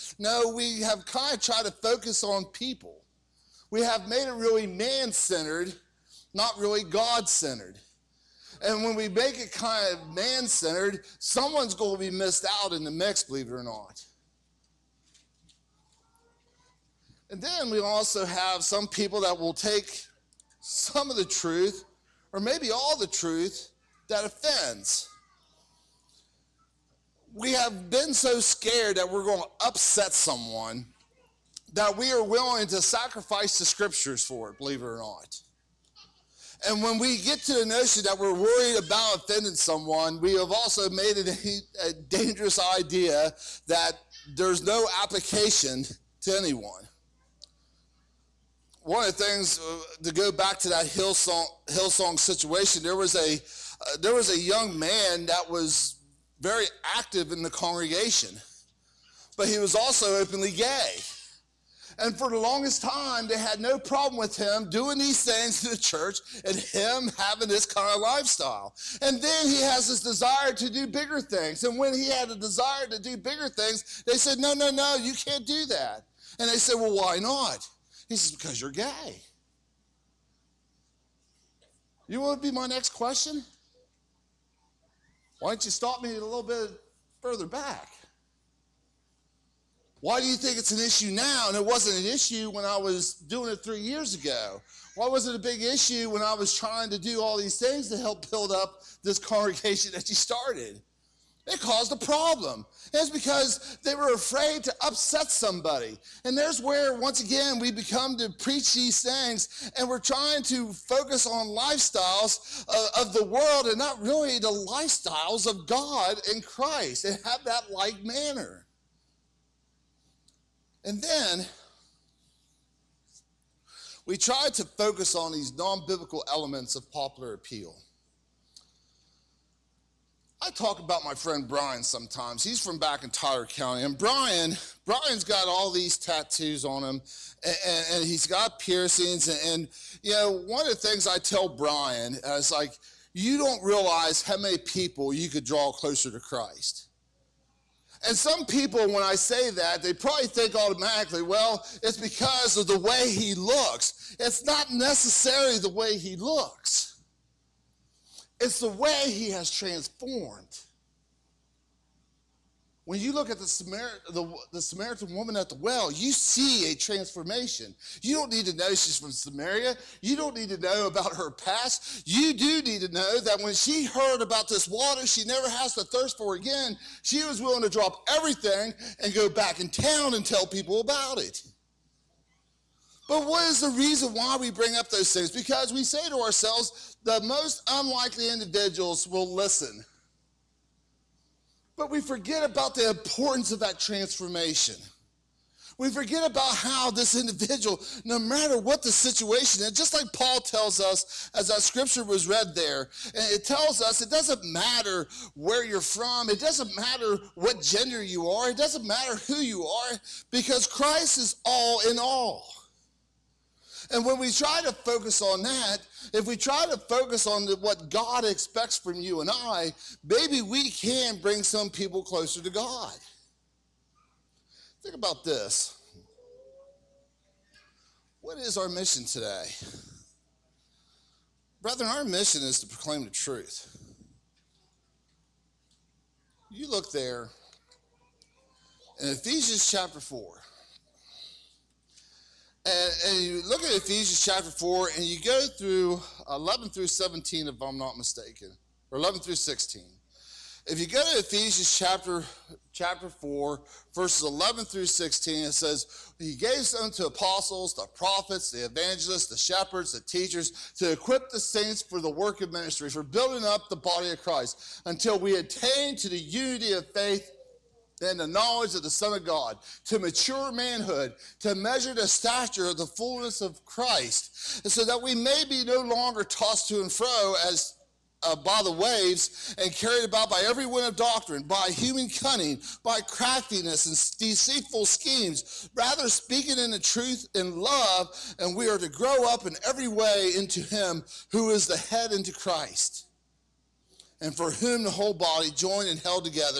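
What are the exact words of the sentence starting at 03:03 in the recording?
But what is the reason why we bring up those things?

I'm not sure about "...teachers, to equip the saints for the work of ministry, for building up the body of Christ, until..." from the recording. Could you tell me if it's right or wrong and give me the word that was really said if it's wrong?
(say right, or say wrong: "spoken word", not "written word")
right.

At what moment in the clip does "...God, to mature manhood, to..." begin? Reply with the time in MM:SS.
04:29.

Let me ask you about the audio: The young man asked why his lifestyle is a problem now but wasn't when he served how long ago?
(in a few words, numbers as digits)
3 years ago.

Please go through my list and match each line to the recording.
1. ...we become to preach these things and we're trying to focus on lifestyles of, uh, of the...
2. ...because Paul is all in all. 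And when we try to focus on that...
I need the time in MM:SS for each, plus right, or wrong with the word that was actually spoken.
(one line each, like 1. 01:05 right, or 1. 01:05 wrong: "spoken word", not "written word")
1. 01:47 right
2. 03:30 wrong: "Christ", not "Paul".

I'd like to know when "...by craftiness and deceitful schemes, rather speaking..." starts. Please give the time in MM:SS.
04:42.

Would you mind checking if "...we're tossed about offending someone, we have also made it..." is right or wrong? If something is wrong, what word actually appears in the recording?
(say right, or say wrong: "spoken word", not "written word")
wrong: "worried", not "tossed".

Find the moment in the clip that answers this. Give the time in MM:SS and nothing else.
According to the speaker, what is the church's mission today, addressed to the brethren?
03:52.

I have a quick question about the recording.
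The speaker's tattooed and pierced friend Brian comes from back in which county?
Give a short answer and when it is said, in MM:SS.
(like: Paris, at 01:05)
Tyler County, at 02:13.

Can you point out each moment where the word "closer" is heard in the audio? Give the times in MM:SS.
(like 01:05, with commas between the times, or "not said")
02:25, 03:42.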